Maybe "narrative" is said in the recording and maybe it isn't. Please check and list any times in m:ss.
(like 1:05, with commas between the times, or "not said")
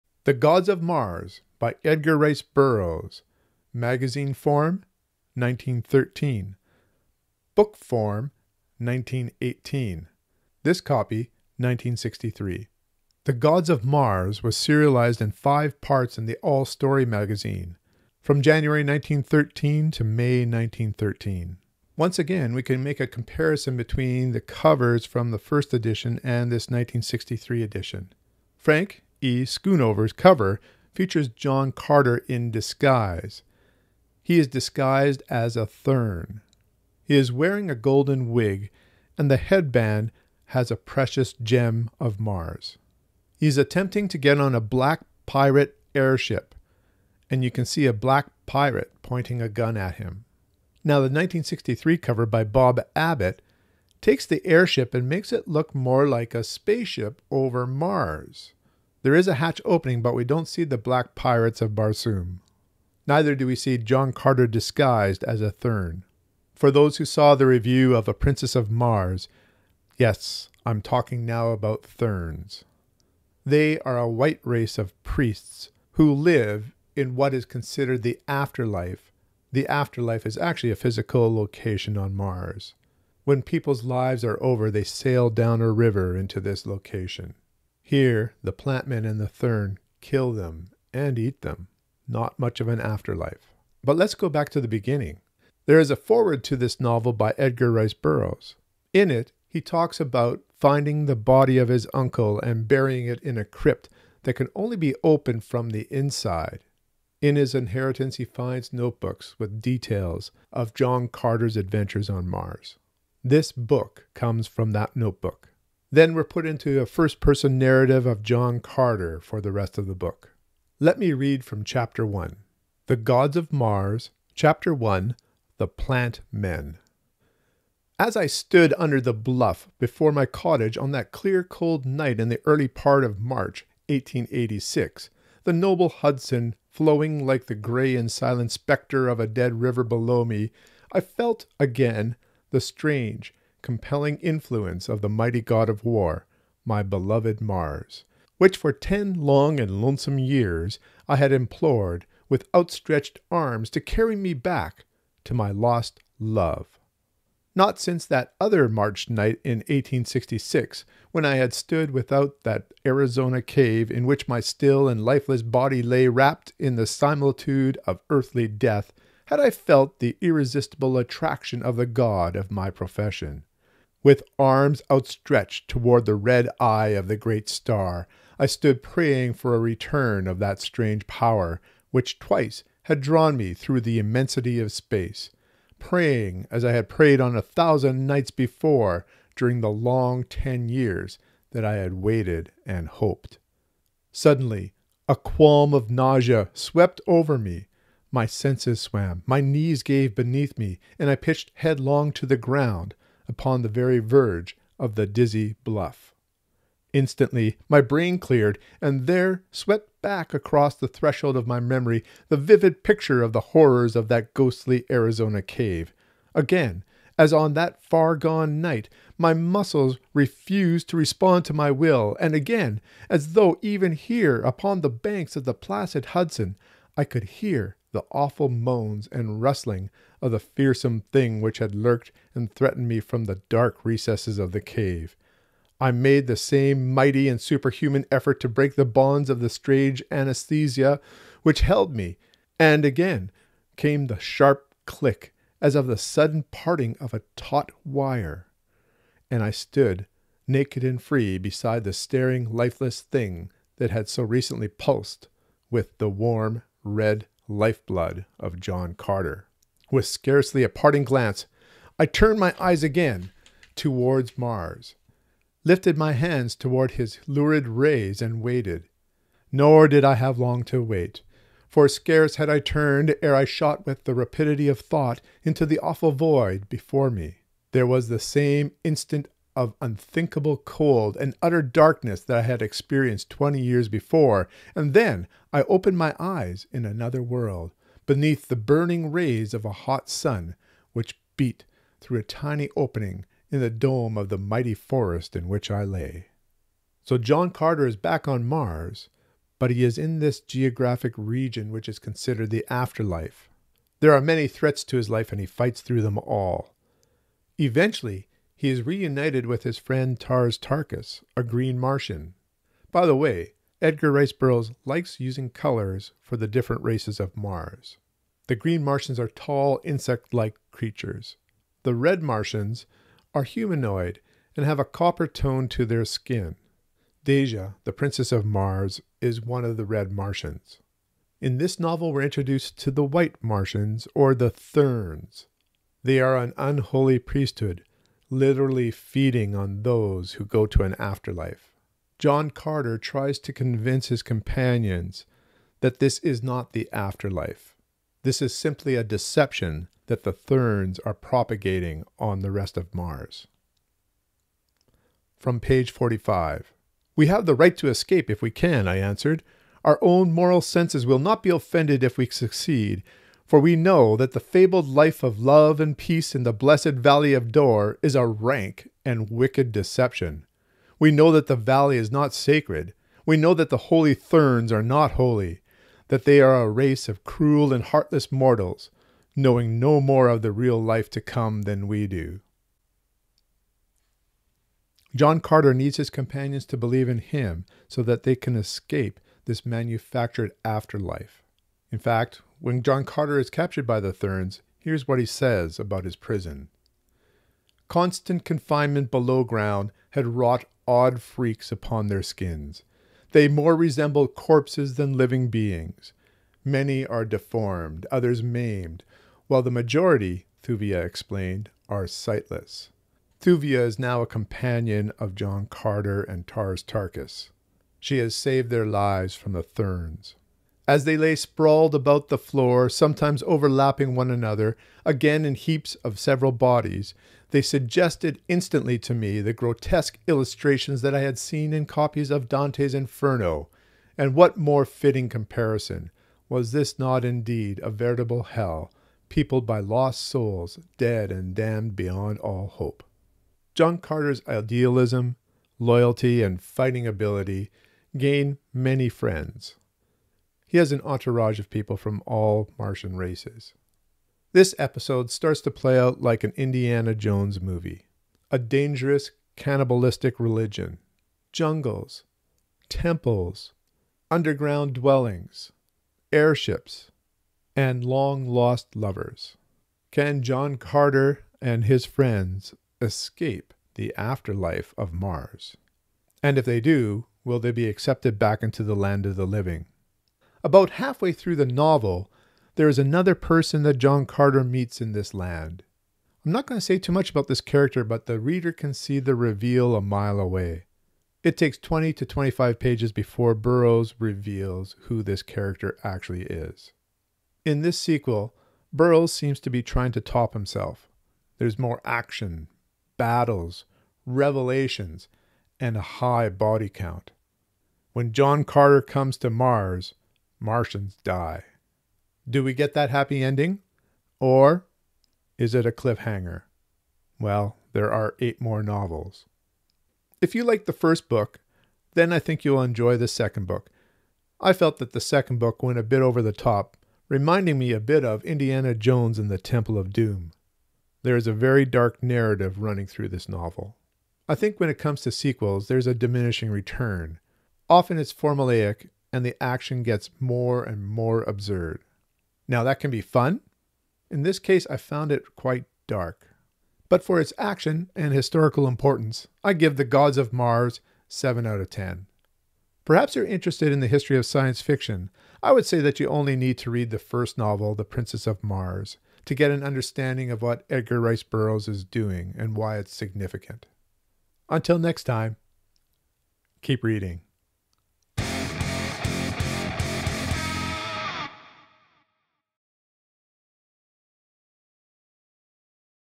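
1:57, 8:52.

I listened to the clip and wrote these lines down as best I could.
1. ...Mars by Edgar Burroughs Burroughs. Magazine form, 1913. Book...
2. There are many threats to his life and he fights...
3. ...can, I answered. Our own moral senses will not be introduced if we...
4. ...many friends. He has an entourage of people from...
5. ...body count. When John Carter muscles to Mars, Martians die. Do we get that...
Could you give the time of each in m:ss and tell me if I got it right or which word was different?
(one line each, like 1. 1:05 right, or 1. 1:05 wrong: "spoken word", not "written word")
1. 0:00 wrong: "Rice", not "Burroughs"
2. 5:03 right
3. 5:58 wrong: "offended", not "introduced"
4. 7:28 right
5. 8:26 wrong: "comes", not "muscles".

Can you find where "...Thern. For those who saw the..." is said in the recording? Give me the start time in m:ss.
1:05.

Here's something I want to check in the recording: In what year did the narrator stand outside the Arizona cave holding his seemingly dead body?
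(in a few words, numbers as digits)
1866.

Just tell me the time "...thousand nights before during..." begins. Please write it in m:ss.
3:07.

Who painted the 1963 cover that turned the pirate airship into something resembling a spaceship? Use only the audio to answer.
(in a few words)
Bob Abbett.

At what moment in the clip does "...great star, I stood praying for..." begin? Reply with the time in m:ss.
2:57.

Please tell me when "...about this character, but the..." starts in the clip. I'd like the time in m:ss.
8:07.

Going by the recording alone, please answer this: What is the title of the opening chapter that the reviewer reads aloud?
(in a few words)
The Plant Men.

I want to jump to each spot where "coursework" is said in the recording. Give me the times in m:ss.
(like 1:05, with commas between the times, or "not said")
not said.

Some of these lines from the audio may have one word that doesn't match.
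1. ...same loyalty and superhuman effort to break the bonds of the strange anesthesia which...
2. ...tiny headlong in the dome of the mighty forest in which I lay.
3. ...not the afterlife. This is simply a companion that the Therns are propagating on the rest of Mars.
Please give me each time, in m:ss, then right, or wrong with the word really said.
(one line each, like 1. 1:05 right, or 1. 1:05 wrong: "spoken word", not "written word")
1. 3:56 wrong: "mighty", not "loyalty"
2. 4:52 wrong: "opening", not "headlong"
3. 5:46 wrong: "deception", not "companion".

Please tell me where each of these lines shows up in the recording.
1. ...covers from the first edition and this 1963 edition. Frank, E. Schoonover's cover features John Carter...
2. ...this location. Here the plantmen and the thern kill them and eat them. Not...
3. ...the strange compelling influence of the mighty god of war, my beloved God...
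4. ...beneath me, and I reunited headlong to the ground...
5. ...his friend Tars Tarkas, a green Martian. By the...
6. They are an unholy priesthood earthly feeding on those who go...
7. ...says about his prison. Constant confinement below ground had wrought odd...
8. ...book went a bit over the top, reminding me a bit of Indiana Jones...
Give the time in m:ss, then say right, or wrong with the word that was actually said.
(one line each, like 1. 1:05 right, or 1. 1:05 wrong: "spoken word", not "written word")
1. 0:24 right
2. 1:26 right
3. 2:22 wrong: "Mars", not "God"
4. 3:20 wrong: "pitched", not "reunited"
5. 5:09 right
6. 5:36 wrong: "literally", not "earthly"
7. 6:35 right
8. 8:45 right.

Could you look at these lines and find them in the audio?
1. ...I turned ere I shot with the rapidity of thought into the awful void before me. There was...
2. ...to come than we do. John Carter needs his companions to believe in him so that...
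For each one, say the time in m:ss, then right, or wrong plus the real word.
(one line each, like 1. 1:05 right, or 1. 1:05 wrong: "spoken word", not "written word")
1. 4:32 right
2. 6:21 right.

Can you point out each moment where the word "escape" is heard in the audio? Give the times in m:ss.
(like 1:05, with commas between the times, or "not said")
5:57, 6:28, 7:53.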